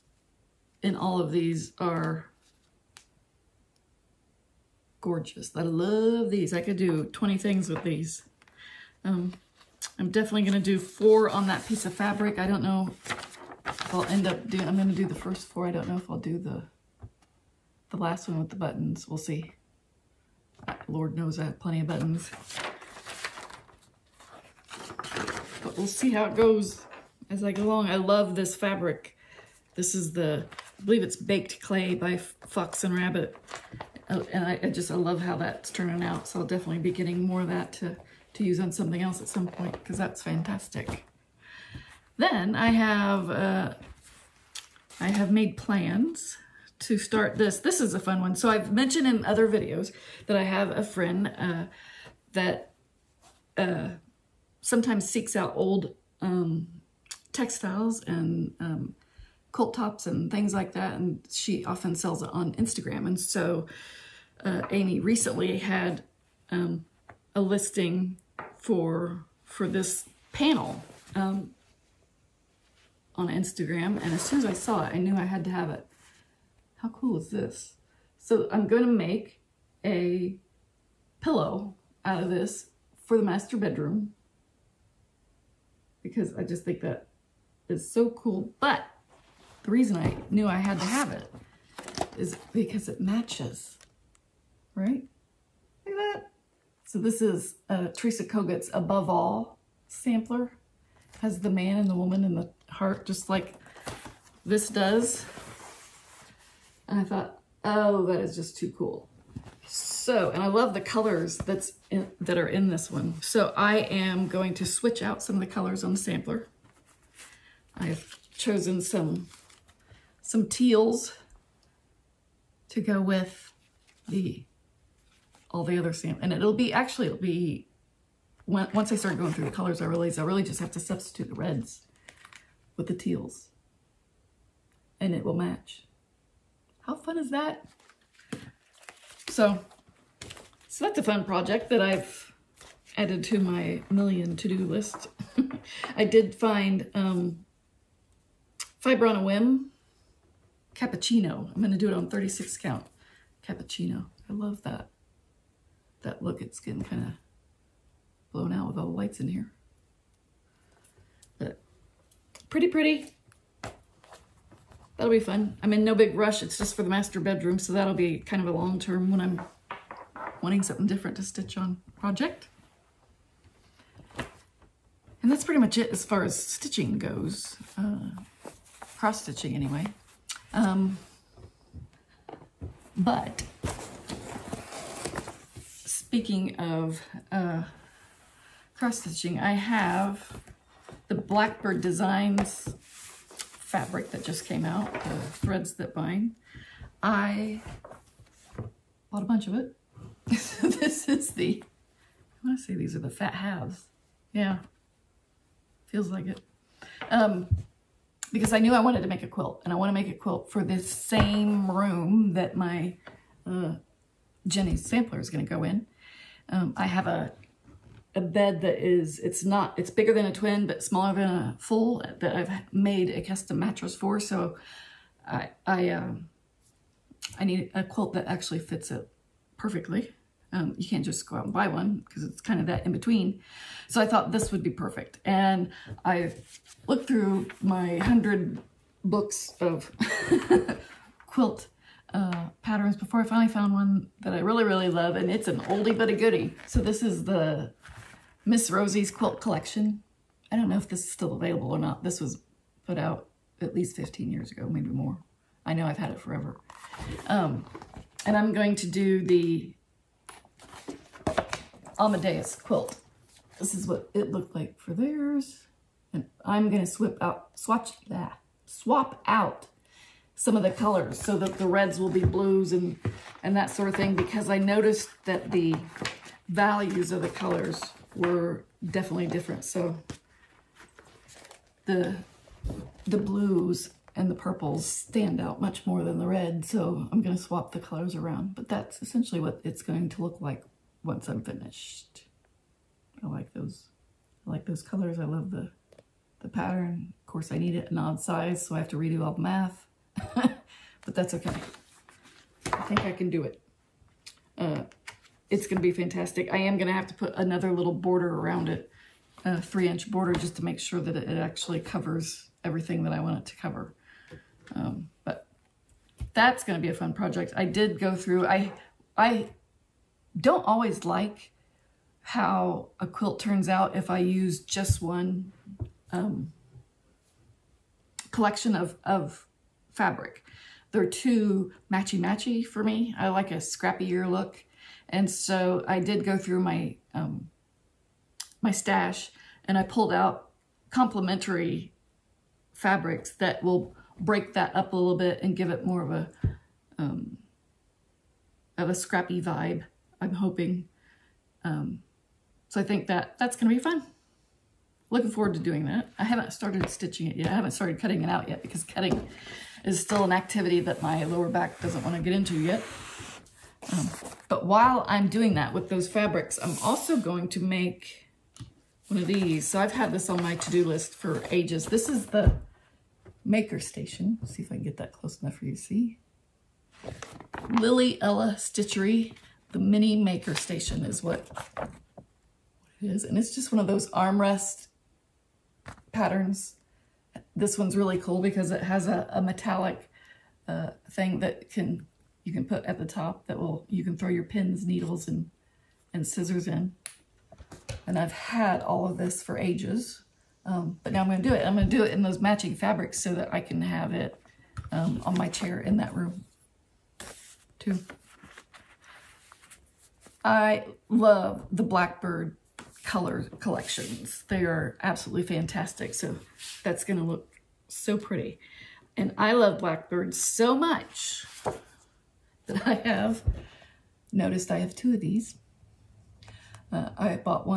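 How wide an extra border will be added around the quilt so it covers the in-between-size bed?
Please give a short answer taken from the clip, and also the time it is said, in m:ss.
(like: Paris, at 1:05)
3 inches, at 5:09.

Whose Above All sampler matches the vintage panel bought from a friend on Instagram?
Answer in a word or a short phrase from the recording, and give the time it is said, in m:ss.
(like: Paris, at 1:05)
Teresa Kogut, at 1:37.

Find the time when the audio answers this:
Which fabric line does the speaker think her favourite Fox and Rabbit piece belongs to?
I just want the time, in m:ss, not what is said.
0:31.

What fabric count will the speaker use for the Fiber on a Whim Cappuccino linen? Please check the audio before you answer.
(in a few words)
36.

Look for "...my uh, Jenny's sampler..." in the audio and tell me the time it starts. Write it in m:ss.
3:32.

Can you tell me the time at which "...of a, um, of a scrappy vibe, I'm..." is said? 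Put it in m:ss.
5:46.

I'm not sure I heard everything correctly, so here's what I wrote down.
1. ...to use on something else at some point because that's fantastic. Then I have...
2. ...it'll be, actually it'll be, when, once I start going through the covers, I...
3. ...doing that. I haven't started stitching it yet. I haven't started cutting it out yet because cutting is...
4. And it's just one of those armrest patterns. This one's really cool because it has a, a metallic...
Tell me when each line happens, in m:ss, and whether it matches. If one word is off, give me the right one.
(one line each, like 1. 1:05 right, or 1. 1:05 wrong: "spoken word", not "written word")
1. 0:38 right
2. 2:06 wrong: "colors", not "covers"
3. 5:55 right
4. 6:23 right.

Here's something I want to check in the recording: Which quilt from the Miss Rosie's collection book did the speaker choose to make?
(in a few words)
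Amadeus.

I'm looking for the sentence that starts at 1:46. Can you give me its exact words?
And I thought, oh, that is just too cool.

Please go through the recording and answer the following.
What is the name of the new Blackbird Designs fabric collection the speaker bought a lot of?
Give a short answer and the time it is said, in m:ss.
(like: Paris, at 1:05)
Threads That Bind, at 3:15.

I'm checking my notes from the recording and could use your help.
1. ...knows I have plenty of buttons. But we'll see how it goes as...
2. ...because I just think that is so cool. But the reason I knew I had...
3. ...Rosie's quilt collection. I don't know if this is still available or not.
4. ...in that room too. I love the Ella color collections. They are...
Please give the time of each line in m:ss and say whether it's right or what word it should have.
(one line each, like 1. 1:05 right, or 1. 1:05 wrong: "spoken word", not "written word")
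1. 0:21 right
2. 1:26 right
3. 4:08 right
4. 6:45 wrong: "Blackbird", not "Ella".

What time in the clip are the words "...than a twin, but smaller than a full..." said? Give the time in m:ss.
3:40.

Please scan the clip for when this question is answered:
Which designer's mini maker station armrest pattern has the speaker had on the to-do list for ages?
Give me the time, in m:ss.
6:17.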